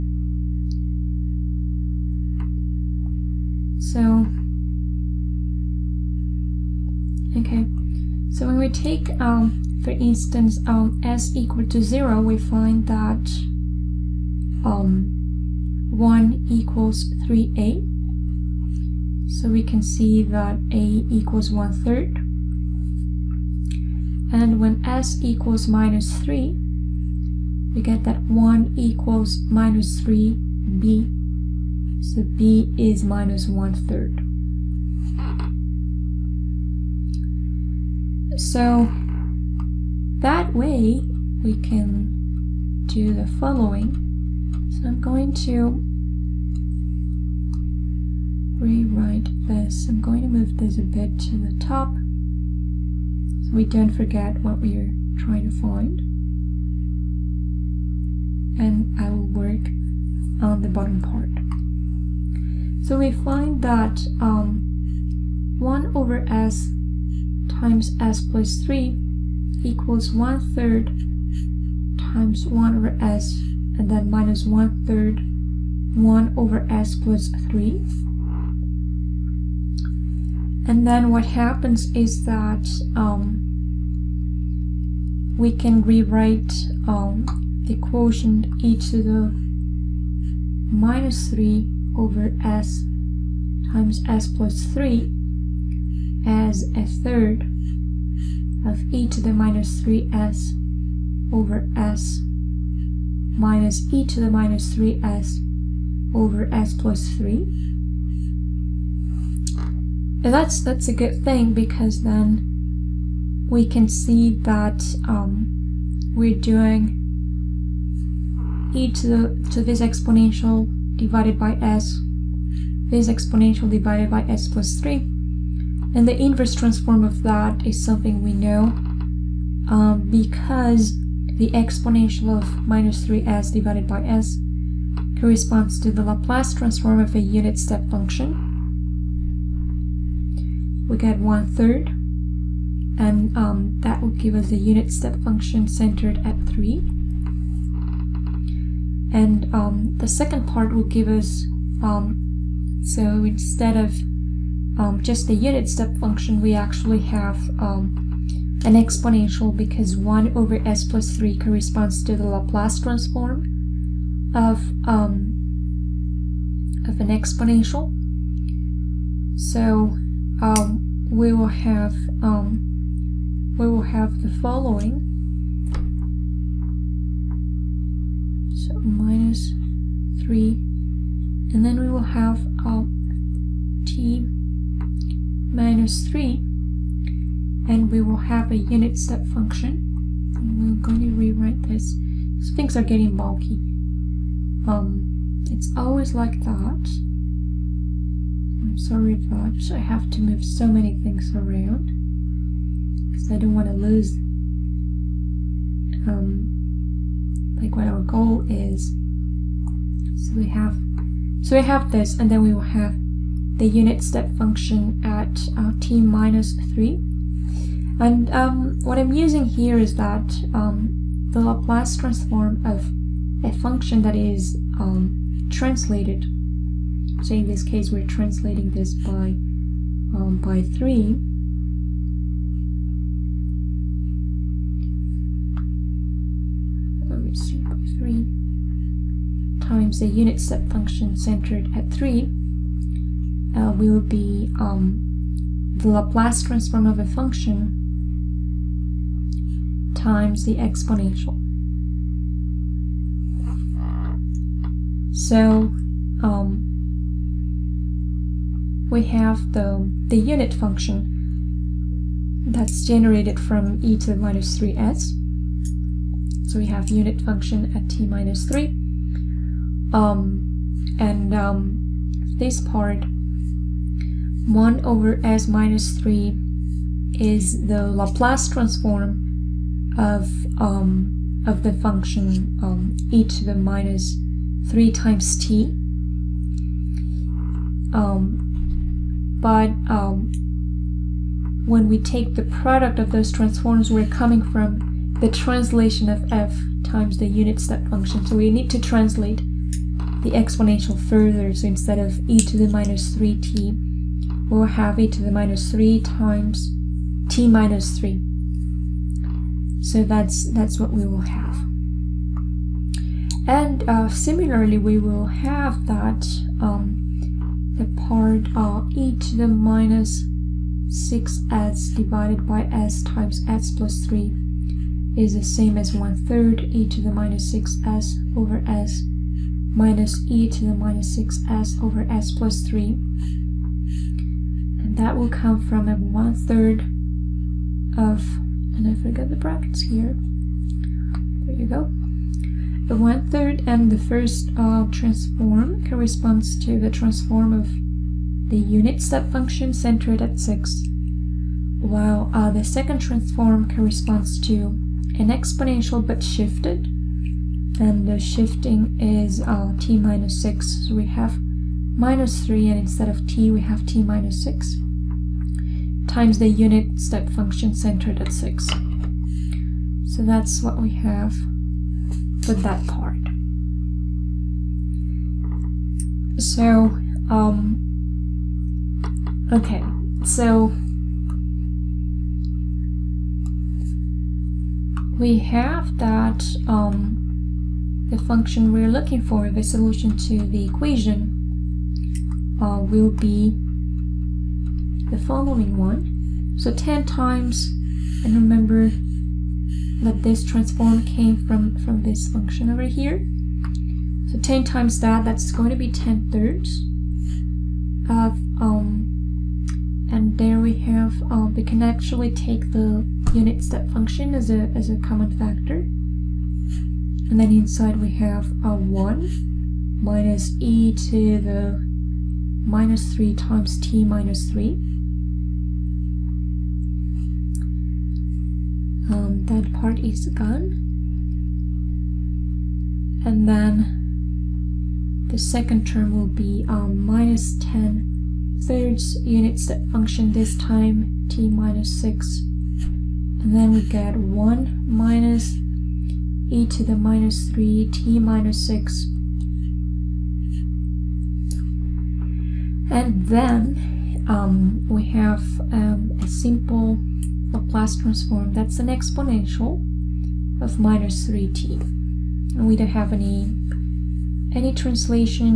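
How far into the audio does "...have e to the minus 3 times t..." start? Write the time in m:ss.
5:04.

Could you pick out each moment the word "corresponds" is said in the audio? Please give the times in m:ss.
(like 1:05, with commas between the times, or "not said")
2:15, 2:41, 5:45, 5:53.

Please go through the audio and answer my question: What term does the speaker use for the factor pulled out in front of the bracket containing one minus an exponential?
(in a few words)
common factor.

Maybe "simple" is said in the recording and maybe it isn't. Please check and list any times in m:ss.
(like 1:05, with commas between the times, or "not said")
7:36.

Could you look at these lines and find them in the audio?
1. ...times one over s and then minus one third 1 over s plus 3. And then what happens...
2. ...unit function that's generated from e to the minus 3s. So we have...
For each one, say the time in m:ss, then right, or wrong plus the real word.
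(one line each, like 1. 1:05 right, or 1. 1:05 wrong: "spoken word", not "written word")
1. 1:11 right
2. 4:20 right.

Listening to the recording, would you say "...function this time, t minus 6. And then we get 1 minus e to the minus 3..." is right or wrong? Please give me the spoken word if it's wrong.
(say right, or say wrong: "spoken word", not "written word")
right.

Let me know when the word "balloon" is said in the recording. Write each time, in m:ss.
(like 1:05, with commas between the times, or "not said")
not said.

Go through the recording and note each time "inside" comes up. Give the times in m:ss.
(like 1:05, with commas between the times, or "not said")
6:57.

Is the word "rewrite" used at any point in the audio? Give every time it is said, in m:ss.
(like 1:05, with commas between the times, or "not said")
0:48, 1:25, 3:11.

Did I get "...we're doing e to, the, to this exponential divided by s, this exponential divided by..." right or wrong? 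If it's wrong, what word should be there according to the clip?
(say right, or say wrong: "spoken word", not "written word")
right.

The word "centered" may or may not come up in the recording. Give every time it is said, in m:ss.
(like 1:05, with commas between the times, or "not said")
2:25, 4:01, 5:49, 6:07.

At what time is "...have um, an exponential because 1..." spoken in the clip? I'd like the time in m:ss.
2:36.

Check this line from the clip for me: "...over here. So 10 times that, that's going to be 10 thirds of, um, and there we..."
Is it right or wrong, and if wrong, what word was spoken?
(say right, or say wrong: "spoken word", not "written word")
right.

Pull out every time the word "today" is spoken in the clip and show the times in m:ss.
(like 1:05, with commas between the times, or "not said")
not said.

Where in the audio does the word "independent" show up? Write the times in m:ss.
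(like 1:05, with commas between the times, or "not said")
not said.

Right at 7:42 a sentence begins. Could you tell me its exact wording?
And we don't have any any translation.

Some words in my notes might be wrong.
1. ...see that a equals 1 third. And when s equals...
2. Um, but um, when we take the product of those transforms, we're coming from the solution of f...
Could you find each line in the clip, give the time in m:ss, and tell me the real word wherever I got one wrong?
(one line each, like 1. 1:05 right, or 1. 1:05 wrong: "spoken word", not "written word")
1. 0:19 right
2. 4:47 wrong: "translation", not "solution".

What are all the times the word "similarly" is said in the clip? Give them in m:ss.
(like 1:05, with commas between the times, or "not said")
5:14.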